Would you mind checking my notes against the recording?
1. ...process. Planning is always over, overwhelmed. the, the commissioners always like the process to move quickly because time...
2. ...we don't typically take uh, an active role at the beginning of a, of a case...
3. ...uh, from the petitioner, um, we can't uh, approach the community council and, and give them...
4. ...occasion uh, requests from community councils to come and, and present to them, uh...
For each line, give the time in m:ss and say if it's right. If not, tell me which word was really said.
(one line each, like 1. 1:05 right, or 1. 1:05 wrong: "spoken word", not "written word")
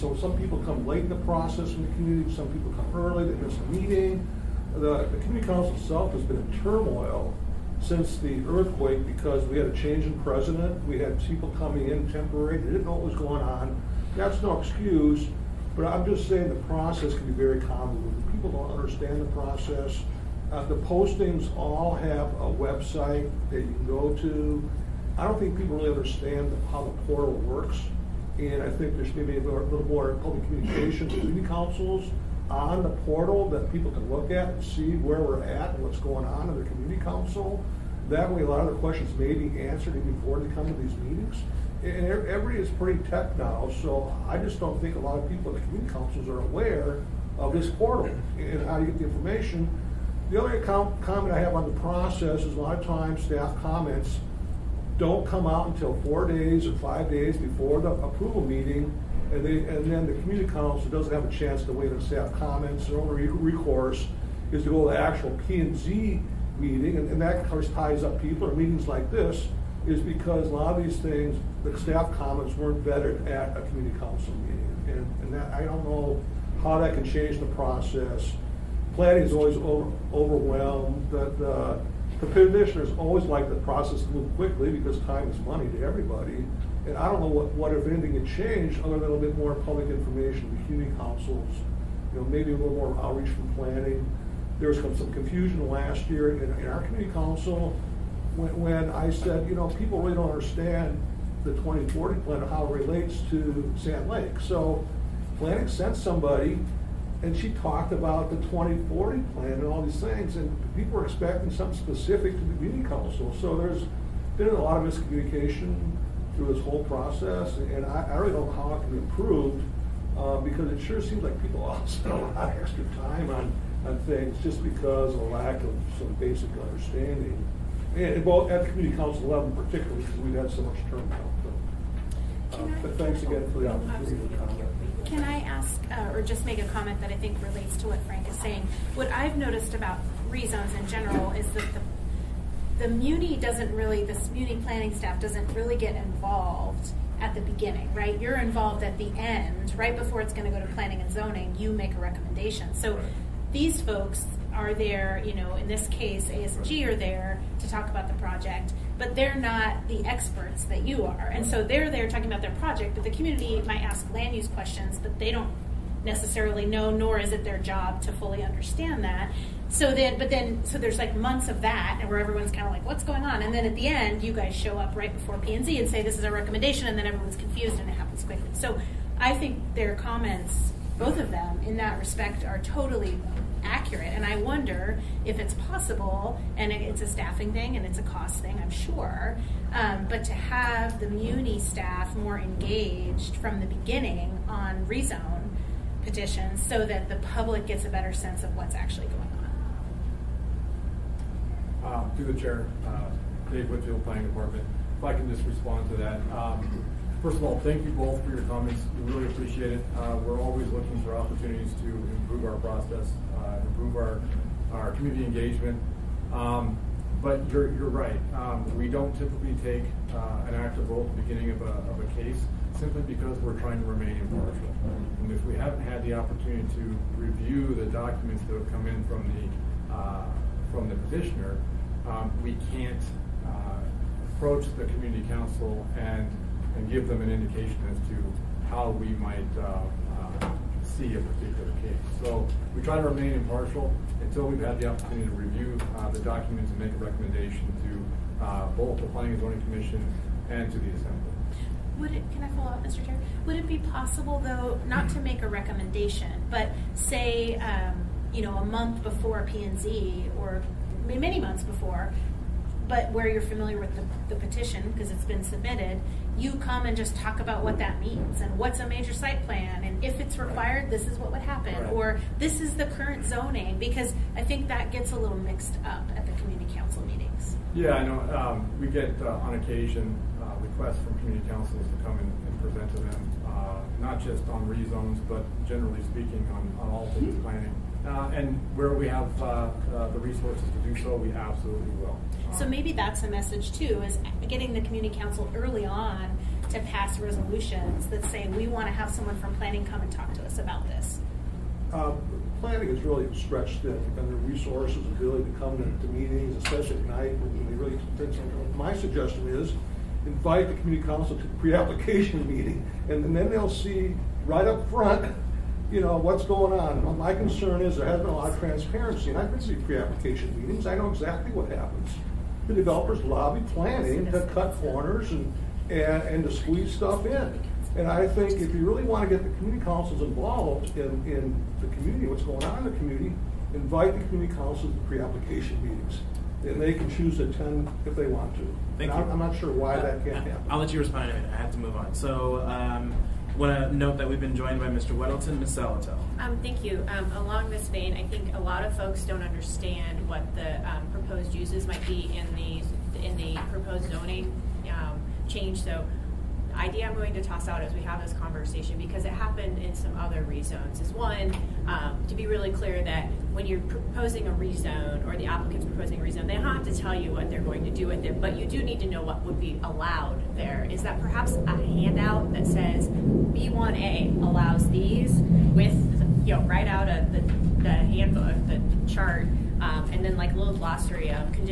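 1. 1:17 right
2. 3:38 right
3. 3:49 right
4. 4:39 right.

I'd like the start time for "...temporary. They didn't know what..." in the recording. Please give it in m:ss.
0:12.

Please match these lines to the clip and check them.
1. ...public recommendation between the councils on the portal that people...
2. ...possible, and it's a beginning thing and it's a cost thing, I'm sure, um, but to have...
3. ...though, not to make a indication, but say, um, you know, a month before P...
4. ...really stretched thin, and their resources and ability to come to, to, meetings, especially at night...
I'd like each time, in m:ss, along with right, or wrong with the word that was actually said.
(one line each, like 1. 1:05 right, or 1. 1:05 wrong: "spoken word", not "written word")
1. 0:30 wrong: "communication", not "recommendation"
2. 3:05 wrong: "staffing", not "beginning"
3. 4:14 wrong: "recommendation", not "indication"
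4. 5:03 right.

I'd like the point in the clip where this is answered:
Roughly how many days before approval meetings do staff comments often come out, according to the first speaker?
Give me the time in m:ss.
0:56.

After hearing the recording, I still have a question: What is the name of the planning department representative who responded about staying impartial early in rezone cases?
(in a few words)
Dave Whitfield.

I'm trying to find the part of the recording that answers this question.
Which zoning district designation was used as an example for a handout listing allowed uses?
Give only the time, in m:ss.
6:13.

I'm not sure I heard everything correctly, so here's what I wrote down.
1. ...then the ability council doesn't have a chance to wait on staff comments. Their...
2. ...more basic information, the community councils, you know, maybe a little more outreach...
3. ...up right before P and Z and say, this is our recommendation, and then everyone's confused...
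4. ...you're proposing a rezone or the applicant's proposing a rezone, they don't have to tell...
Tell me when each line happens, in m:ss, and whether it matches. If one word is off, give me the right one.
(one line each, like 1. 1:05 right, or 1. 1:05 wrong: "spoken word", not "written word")
1. 0:59 wrong: "community", not "ability"
2. 1:29 wrong: "public", not "basic"
3. 2:54 right
4. 6:03 right.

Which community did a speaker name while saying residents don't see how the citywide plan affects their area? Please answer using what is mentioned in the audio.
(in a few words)
Sand Lake.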